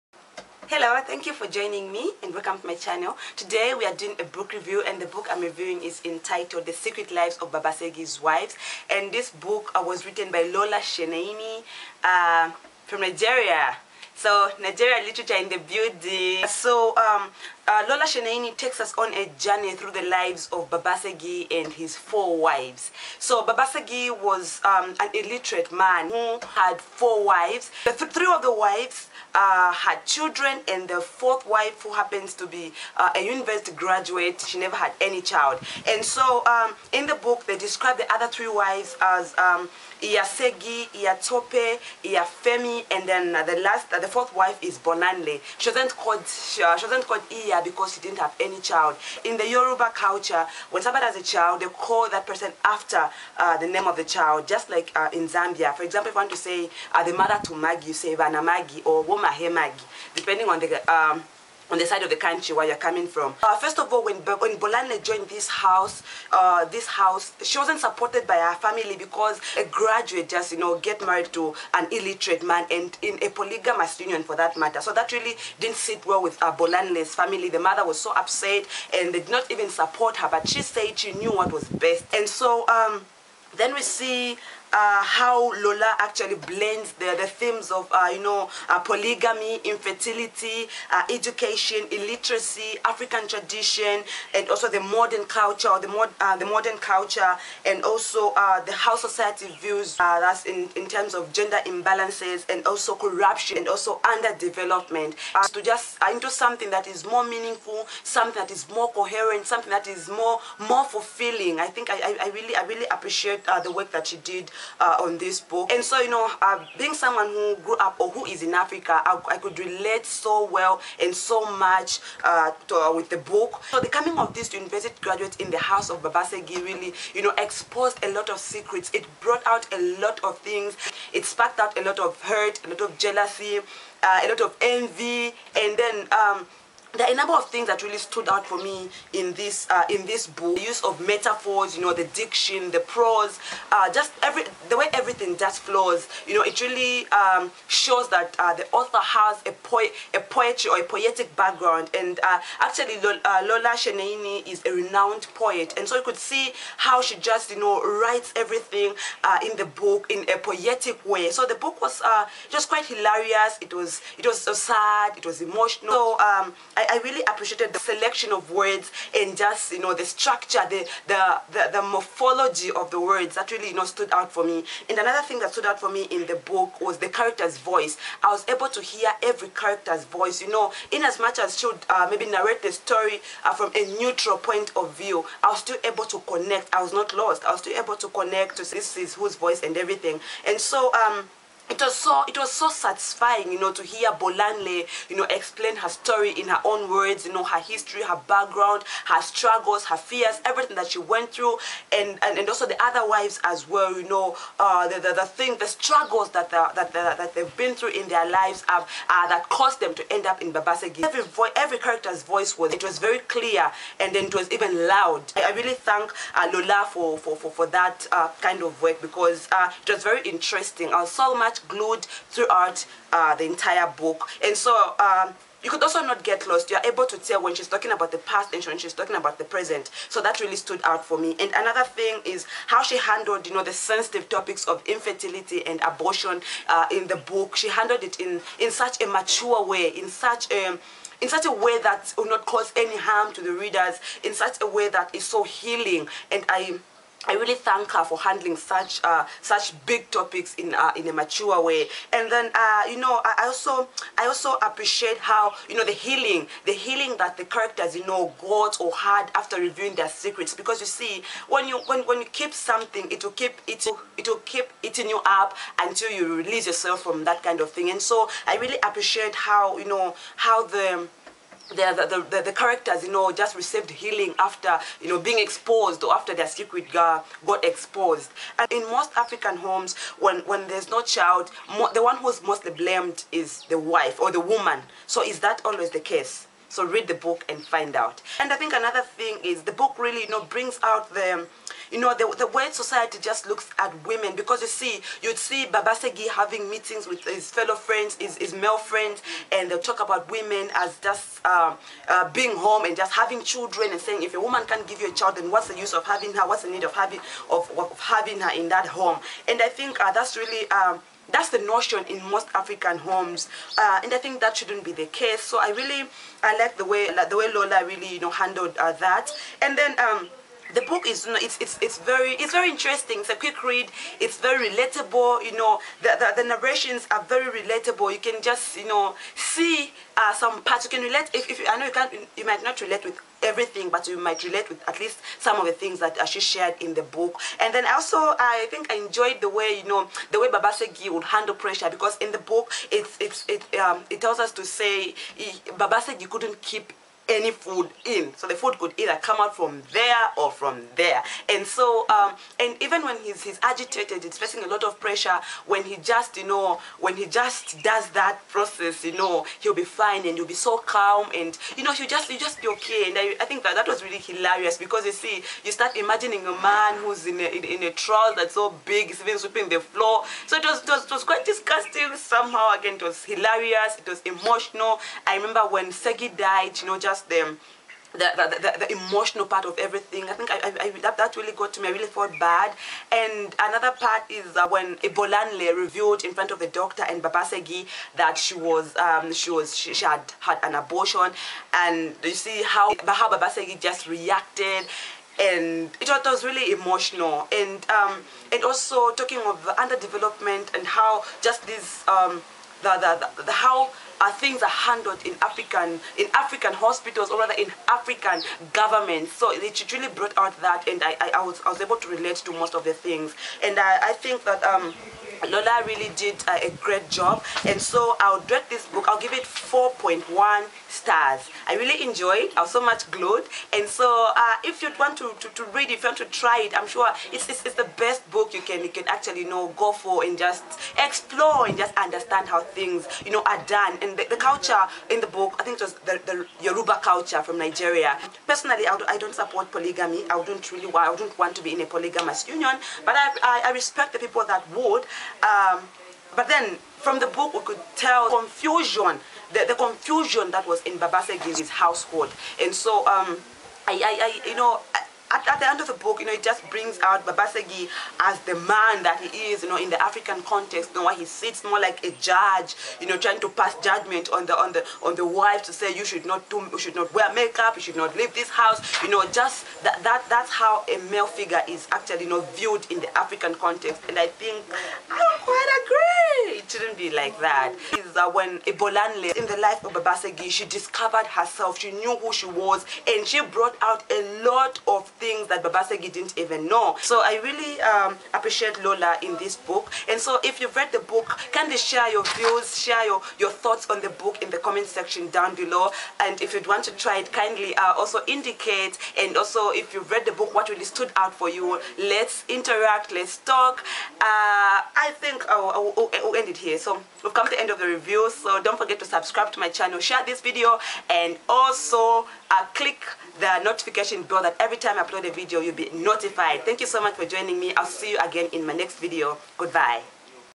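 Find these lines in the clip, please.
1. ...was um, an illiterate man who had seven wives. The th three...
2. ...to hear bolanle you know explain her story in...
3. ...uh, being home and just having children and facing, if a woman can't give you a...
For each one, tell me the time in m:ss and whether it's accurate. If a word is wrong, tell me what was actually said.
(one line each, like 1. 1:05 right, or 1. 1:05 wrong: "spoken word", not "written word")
1. 0:24 wrong: "four", not "seven"
2. 3:13 right
3. 5:02 wrong: "saying", not "facing".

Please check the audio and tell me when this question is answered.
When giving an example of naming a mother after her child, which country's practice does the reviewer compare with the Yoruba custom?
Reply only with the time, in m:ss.
0:55.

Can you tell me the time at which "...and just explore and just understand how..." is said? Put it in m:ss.
7:10.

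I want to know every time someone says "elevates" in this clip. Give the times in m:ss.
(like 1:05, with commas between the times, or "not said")
not said.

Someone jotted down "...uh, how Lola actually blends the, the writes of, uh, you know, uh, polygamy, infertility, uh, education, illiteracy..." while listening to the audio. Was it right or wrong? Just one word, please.
wrong.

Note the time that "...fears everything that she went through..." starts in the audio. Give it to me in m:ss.
3:19.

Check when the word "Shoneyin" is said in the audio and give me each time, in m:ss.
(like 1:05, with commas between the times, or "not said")
0:10, 0:18, 2:33.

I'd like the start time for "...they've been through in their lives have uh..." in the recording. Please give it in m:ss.
3:27.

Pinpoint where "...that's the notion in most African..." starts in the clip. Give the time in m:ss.
5:11.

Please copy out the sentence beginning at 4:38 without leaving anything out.
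And in most African homes, when, when there's no child, the one who's mostly blamed is the wife or the woman.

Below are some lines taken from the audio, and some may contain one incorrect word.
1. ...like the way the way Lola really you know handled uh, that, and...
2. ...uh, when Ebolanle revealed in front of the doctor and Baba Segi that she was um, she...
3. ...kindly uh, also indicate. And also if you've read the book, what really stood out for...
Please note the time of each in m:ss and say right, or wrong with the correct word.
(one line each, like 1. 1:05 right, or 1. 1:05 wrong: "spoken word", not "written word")
1. 5:16 right
2. 6:24 right
3. 8:17 right.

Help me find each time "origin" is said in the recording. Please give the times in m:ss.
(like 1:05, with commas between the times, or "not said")
not said.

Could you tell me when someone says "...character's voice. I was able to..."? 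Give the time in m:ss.
2:57.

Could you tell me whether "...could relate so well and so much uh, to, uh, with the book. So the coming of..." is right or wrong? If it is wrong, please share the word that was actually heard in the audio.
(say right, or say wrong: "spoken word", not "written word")
right.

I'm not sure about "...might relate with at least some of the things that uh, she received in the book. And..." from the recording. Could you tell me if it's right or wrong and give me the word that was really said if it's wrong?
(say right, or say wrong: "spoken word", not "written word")
wrong: "shared", not "received".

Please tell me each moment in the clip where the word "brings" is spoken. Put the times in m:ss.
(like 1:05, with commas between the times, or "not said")
4:50, 7:36.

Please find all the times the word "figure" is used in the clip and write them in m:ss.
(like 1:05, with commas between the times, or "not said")
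7:51.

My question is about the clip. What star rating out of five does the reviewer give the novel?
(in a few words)
4.1 stars.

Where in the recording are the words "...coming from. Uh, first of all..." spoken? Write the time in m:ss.
1:02.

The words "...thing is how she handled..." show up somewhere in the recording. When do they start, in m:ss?
3:51.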